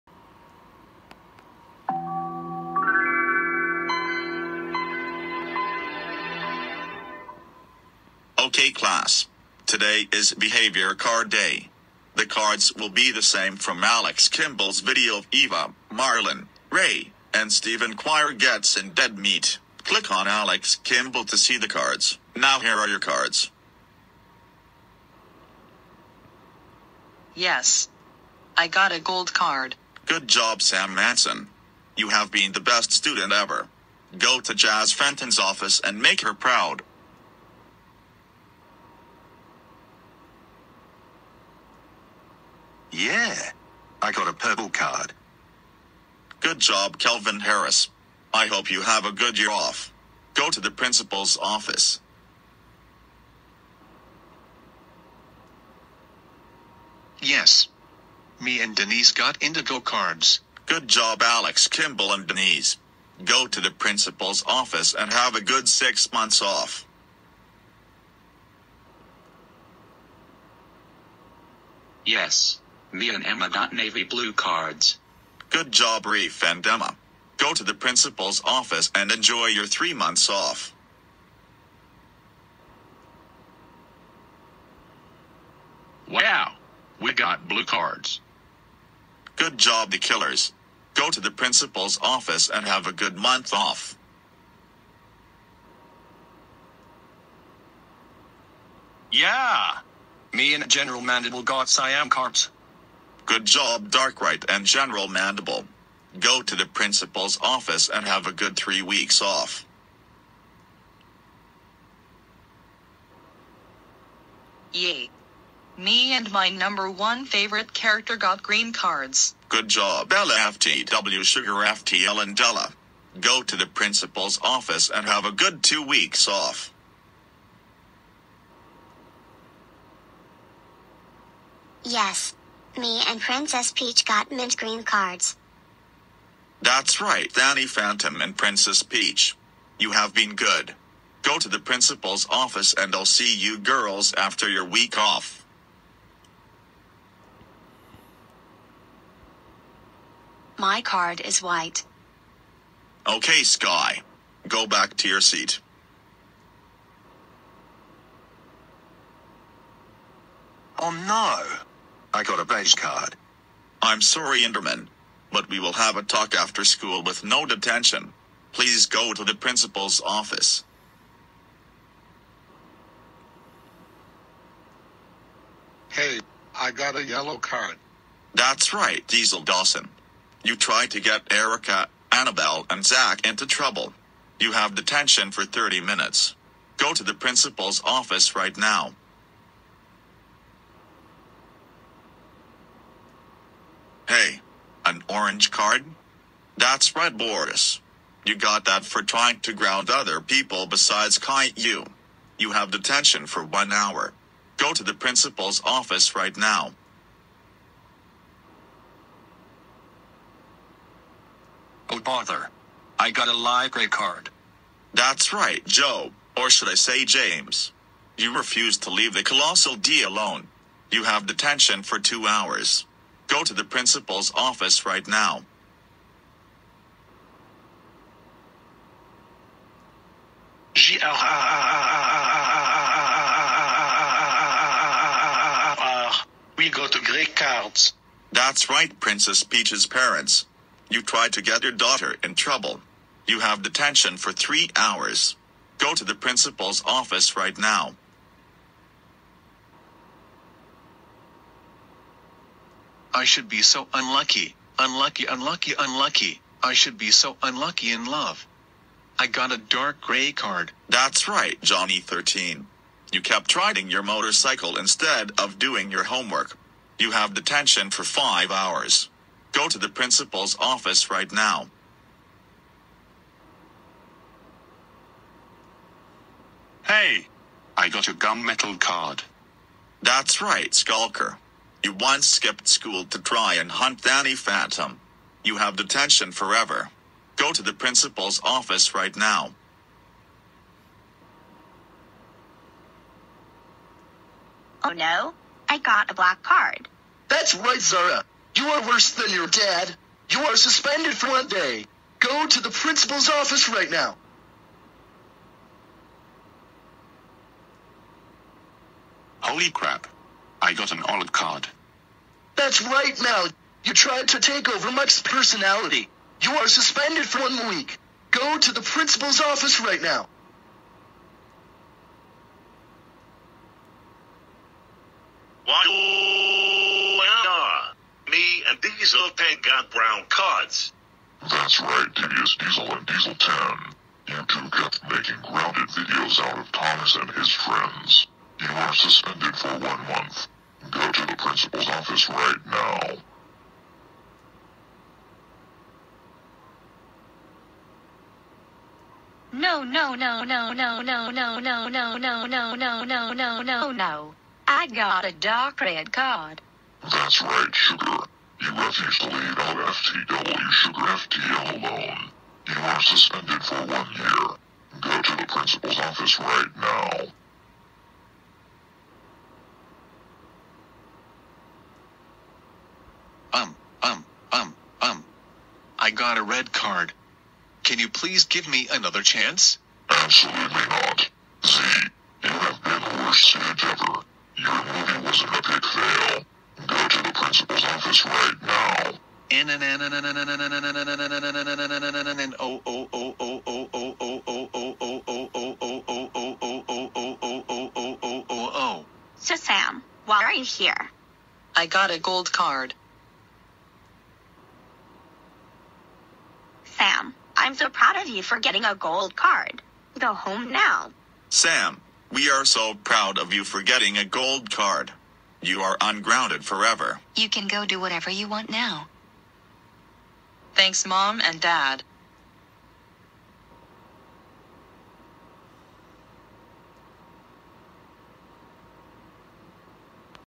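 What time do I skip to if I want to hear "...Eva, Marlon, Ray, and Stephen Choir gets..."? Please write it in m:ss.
0:15.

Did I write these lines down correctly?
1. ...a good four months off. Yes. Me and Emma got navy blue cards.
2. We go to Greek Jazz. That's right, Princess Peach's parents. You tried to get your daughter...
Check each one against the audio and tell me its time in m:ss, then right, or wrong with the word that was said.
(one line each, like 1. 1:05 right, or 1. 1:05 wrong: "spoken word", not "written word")
1. 1:05 wrong: "six", not "four"
2. 3:56 wrong: "Cards", not "Jazz".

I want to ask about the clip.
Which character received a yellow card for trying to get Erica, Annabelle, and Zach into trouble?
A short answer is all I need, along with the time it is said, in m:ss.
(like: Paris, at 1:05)
Diesel Dawson, at 2:59.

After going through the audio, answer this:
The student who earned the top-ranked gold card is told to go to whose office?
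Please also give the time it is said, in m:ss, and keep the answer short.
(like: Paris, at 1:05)
Jazz Fenton, at 0:34.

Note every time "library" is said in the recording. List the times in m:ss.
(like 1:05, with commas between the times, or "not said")
3:33.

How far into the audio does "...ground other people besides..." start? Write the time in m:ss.
3:19.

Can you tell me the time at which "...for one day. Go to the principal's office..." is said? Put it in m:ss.
5:01.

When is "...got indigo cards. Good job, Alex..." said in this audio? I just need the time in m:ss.
0:59.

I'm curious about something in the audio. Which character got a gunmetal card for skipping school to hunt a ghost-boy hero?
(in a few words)
Skulker.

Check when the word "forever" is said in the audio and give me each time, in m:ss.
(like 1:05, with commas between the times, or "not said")
4:46, 6:56.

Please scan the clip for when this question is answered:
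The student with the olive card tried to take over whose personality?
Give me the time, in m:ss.
5:14.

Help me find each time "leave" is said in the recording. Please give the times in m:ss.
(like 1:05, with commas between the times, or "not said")
3:38, 5:59.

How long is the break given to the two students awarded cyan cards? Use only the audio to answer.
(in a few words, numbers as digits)
3 weeks.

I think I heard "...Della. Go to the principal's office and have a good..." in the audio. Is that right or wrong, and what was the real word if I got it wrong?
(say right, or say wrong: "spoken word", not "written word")
right.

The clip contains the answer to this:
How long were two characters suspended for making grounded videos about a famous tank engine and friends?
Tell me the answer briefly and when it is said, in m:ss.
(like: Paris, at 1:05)
1 month, at 5:39.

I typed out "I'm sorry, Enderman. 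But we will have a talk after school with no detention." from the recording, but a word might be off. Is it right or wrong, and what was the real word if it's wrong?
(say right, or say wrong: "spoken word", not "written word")
right.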